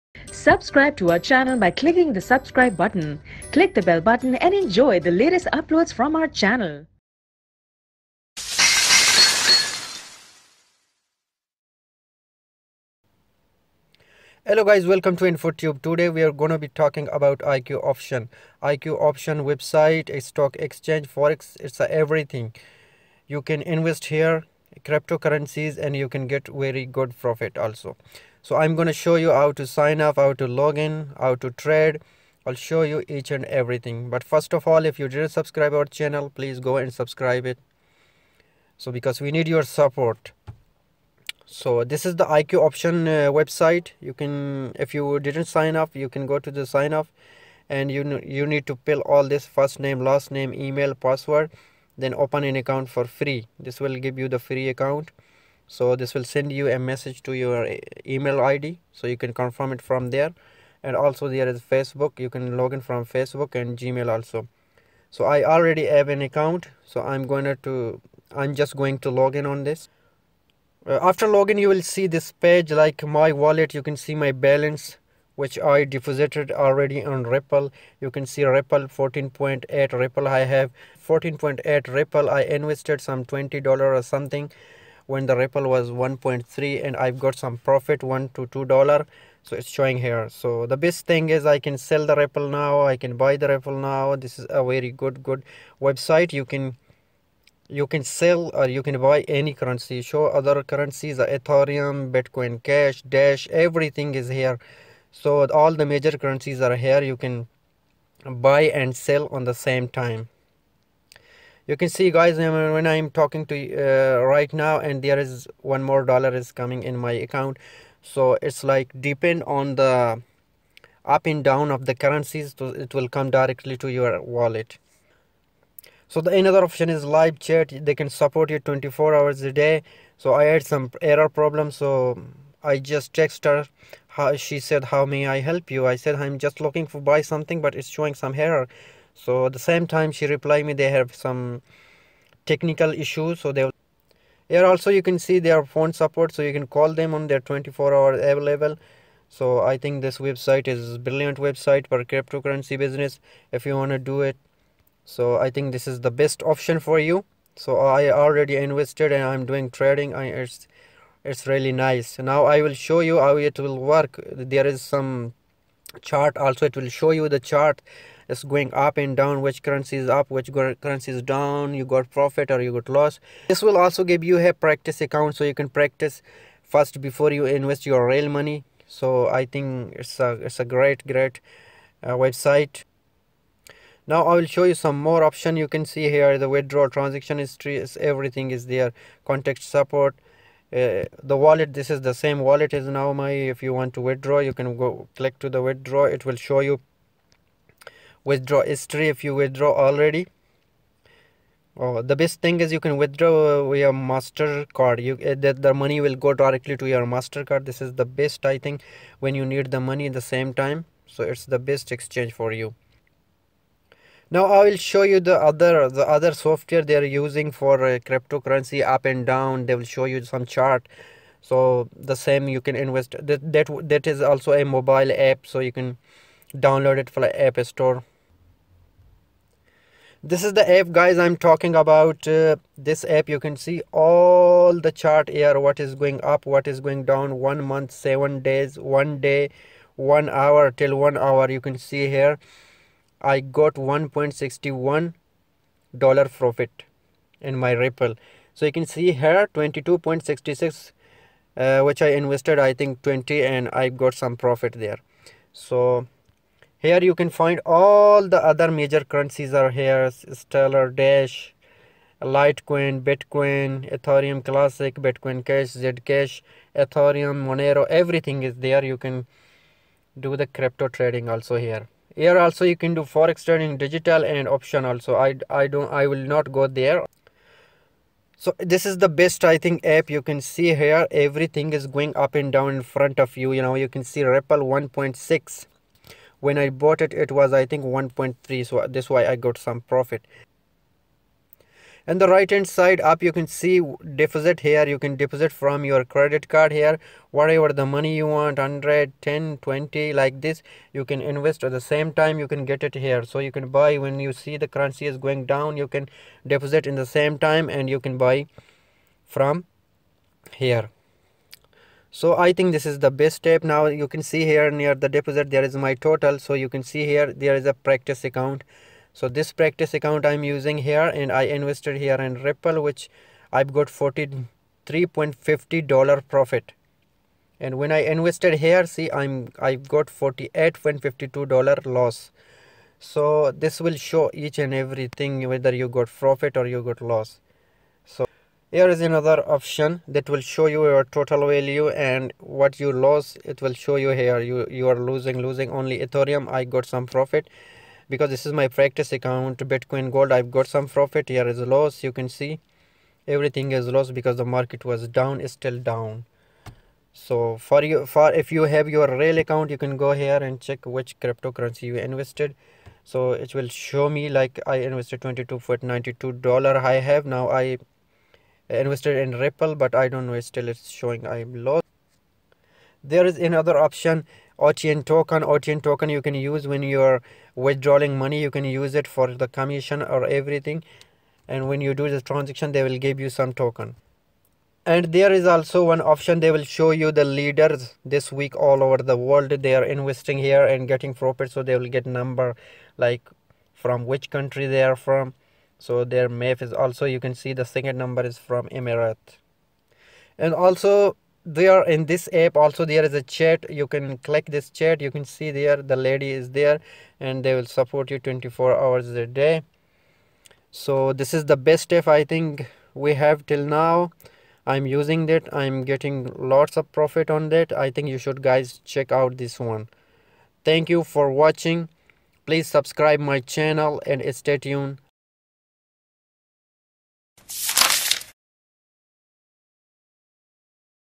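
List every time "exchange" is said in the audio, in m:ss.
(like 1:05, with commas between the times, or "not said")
0:20, 3:31.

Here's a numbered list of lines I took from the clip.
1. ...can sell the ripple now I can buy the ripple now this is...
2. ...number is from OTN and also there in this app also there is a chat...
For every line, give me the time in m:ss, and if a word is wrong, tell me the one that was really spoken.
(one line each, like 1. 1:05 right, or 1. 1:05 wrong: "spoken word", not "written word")
1. 1:31 right
2. 6:37 wrong: "Emirat", not "OTN".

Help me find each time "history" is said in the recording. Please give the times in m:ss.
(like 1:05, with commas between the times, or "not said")
3:07, 3:18.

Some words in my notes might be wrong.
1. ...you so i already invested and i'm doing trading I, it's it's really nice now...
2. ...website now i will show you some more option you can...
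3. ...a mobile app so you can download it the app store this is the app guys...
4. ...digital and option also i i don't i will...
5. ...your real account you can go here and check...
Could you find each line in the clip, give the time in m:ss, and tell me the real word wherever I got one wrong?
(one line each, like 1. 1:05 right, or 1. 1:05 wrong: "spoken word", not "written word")
1. 2:36 right
2. 3:02 right
3. 3:44 right
4. 4:33 right
5. 5:58 right.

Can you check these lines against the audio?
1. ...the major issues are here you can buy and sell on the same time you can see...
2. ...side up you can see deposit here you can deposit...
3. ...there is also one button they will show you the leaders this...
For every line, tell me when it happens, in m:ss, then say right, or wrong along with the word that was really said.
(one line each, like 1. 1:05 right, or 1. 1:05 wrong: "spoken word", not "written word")
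1. 1:45 wrong: "currencies", not "issues"
2. 4:52 right
3. 6:25 wrong: "option", not "button".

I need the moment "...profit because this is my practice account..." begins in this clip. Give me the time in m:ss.
5:47.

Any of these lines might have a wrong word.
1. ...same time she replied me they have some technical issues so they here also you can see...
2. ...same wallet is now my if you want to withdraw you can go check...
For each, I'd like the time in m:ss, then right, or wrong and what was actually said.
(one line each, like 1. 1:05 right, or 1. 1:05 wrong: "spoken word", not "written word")
1. 2:19 right
2. 3:12 wrong: "click", not "check".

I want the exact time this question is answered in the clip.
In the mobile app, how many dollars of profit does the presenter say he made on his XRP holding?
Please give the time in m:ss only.
4:03.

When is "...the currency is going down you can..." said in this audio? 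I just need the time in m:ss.
5:04.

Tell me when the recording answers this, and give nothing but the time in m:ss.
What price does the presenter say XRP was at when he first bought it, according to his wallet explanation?
1:25.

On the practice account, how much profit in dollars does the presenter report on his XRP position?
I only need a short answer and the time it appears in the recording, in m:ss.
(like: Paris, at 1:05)
43.50 dollars, at 5:23.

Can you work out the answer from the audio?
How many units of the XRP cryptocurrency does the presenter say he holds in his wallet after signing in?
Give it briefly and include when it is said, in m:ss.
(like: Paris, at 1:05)
14.8, at 1:18.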